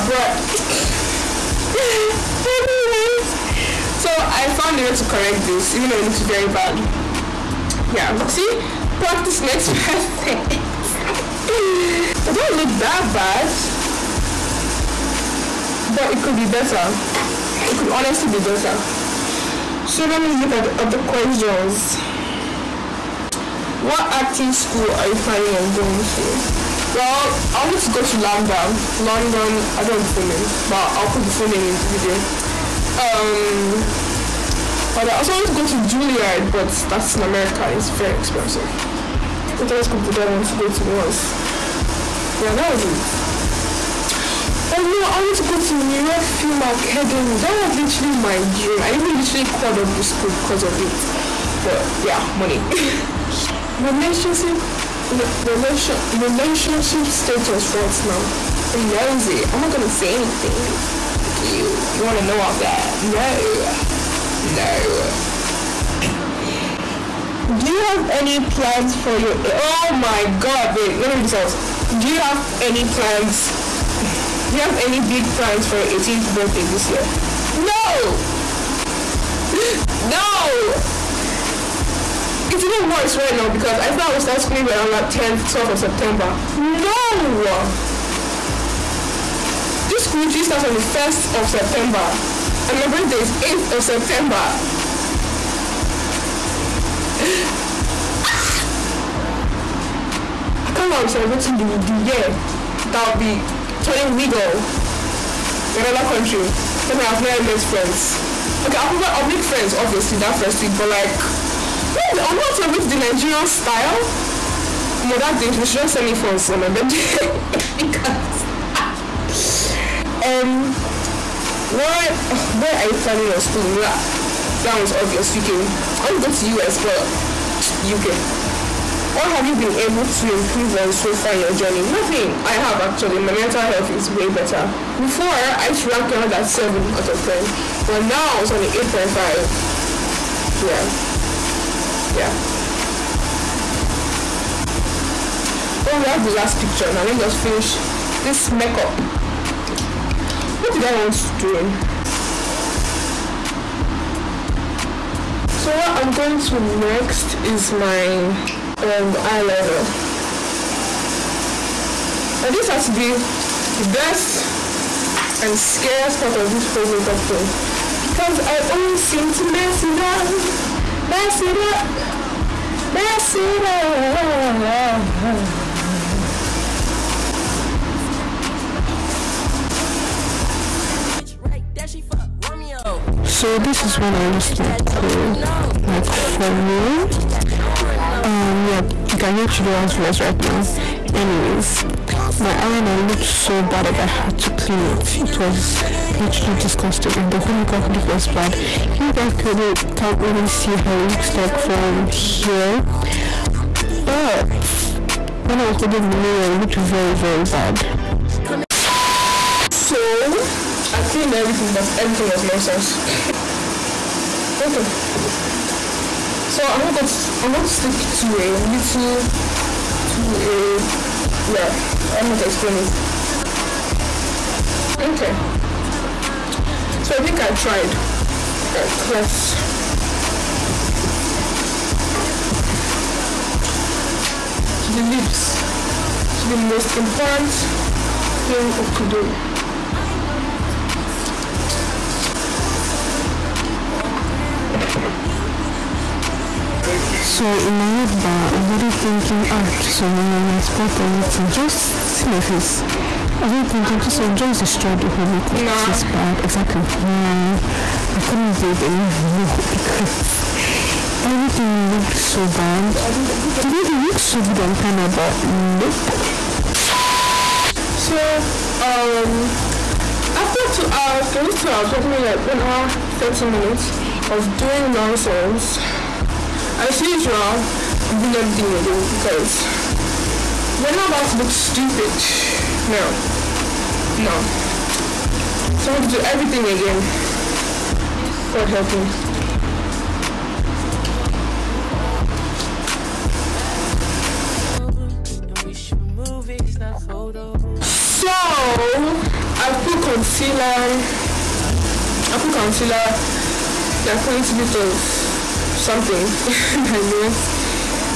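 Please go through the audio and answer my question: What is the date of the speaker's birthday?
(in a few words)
8th of September.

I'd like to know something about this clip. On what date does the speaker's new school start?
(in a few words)
1st of September.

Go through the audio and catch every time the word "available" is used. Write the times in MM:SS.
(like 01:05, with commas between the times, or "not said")
not said.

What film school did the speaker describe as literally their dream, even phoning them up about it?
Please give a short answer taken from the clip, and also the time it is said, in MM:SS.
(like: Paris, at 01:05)
New York Film Academy, at 00:45.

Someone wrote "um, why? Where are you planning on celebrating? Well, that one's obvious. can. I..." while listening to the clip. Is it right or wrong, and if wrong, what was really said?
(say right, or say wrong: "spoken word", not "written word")
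wrong: "schooling", not "celebrating".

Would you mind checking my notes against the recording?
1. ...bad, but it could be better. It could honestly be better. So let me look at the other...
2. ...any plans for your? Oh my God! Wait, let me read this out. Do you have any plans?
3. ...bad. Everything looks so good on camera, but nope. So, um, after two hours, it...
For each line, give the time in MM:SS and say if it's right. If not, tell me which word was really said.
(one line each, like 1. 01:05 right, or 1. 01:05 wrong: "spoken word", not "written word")
1. 00:13 right
2. 01:08 right
3. 04:22 right.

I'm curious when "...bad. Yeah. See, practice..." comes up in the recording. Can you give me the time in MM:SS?
00:06.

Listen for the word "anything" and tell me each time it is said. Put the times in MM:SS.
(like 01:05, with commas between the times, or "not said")
01:00.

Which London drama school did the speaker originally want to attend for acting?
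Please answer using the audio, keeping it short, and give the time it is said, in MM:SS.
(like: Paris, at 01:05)
LAMDA, at 00:28.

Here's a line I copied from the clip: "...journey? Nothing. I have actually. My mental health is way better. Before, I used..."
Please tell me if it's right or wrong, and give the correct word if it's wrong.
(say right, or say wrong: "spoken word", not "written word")
right.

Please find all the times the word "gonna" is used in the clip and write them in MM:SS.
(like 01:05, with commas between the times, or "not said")
00:59.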